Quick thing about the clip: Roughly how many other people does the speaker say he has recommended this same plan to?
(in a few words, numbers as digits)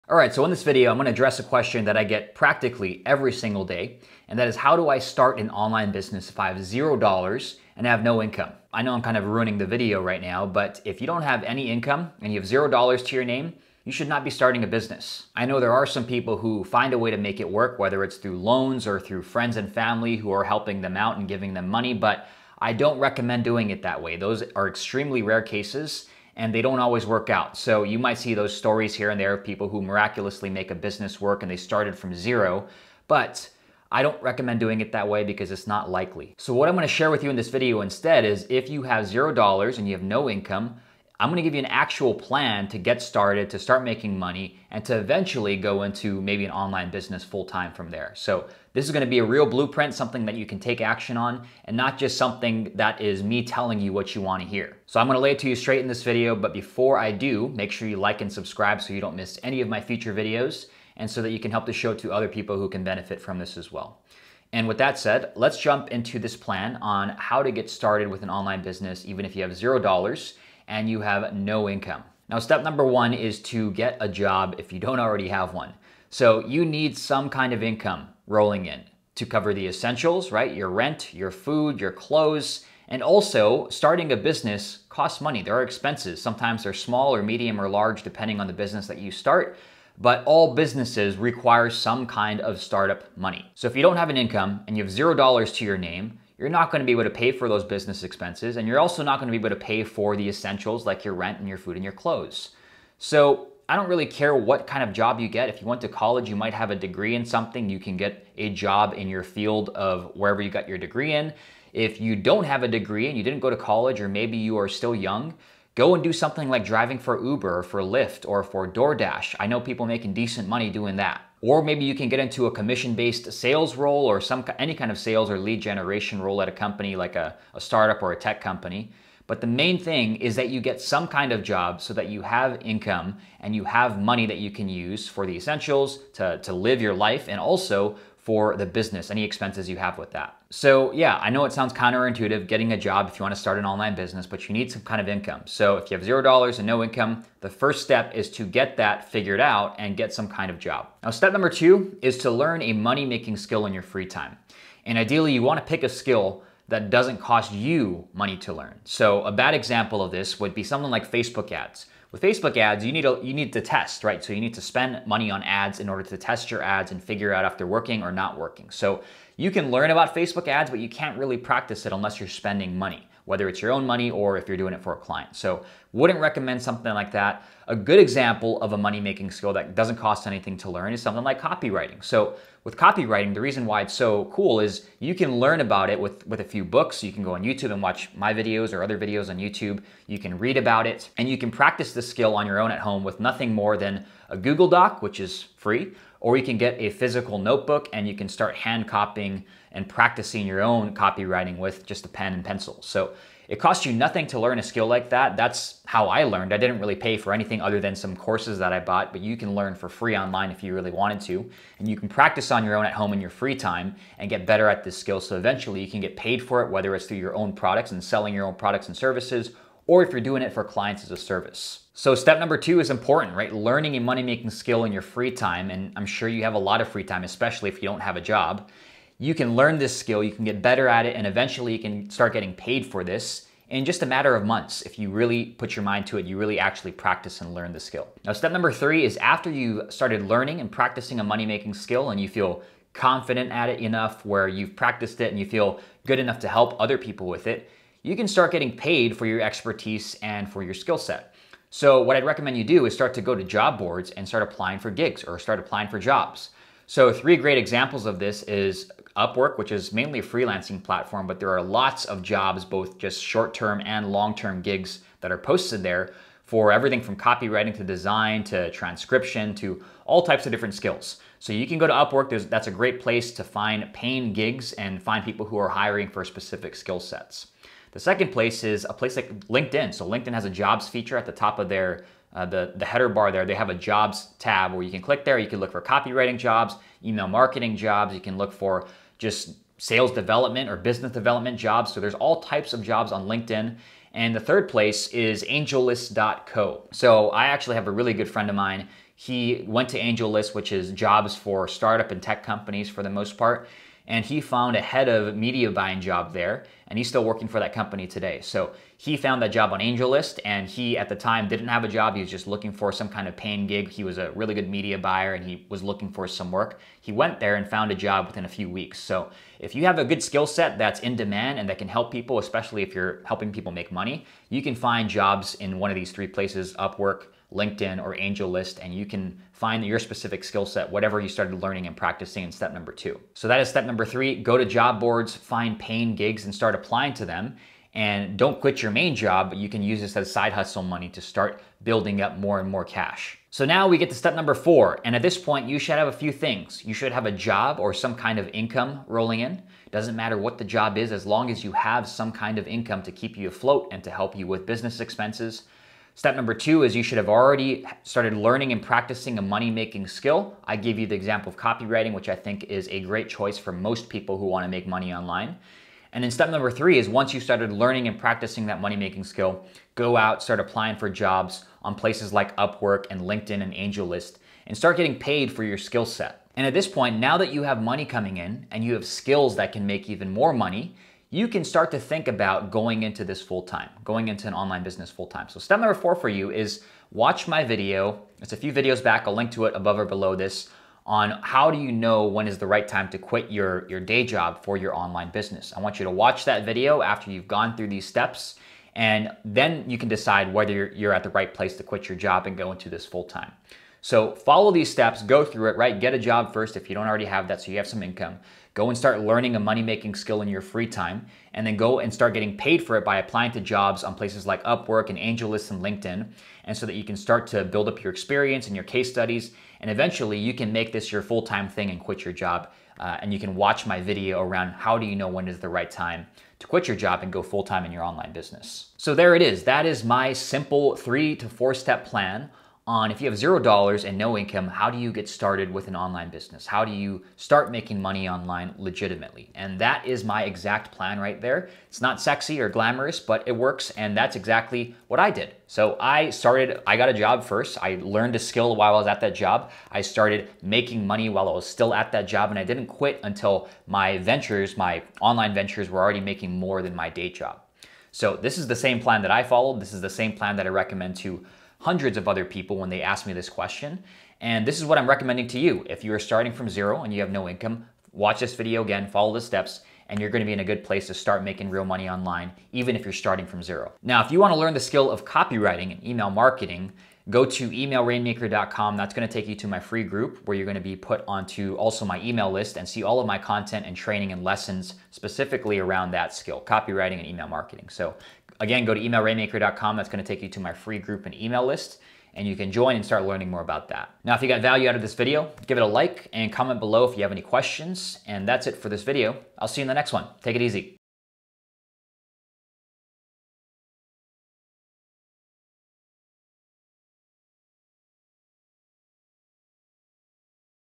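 Hundreds.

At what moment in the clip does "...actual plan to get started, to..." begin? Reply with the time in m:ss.
0:41.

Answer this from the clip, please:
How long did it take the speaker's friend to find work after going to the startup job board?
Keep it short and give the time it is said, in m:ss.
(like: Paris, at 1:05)
A few weeks, at 5:18.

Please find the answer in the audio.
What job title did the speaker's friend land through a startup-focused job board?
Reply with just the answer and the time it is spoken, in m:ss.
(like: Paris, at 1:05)
Head of media buying, at 5:04.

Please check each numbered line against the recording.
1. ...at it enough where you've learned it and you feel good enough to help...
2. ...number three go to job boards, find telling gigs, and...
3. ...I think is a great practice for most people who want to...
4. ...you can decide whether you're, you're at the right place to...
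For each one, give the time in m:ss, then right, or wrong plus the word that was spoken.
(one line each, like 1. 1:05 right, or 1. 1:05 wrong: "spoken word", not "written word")
1. 4:03 wrong: "practiced", not "learned"
2. 5:33 wrong: "paying", not "telling"
3. 6:02 wrong: "choice", not "practice"
4. 6:39 right.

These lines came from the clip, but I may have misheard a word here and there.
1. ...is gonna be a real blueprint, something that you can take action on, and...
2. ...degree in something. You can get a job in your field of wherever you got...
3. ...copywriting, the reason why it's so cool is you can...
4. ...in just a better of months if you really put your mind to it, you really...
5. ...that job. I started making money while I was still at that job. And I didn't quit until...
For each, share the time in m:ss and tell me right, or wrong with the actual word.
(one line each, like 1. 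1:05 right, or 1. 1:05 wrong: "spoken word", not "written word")
1. 0:48 right
2. 1:46 right
3. 3:02 right
4. 3:53 wrong: "matter", not "better"
5. 7:29 right.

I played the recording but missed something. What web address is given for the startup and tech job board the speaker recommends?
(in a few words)
angellist.co.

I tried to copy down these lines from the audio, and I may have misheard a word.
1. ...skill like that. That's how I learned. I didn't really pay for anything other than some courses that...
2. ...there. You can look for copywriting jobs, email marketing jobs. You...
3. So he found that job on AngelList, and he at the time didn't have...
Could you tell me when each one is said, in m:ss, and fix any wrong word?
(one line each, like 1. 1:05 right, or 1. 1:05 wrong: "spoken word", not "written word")
1. 3:24 right
2. 4:45 right
3. 5:08 right.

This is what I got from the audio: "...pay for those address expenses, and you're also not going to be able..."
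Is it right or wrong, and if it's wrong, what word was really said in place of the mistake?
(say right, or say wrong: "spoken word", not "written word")
wrong: "business", not "address".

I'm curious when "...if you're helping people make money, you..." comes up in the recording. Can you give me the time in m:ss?
5:22.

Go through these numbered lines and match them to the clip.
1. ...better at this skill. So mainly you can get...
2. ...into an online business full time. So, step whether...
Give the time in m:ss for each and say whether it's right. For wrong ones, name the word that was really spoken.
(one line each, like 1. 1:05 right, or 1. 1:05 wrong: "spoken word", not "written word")
1. 3:34 wrong: "eventually", not "mainly"
2. 6:24 wrong: "number", not "whether".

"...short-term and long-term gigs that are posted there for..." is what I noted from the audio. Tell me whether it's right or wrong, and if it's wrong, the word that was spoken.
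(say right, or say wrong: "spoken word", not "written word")
right.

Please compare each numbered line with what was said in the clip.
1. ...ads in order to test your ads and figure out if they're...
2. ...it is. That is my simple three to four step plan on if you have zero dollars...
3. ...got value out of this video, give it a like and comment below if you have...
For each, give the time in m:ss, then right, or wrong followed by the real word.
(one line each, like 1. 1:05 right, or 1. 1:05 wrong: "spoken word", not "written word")
1. 2:45 right
2. 7:09 right
3. 8:14 right.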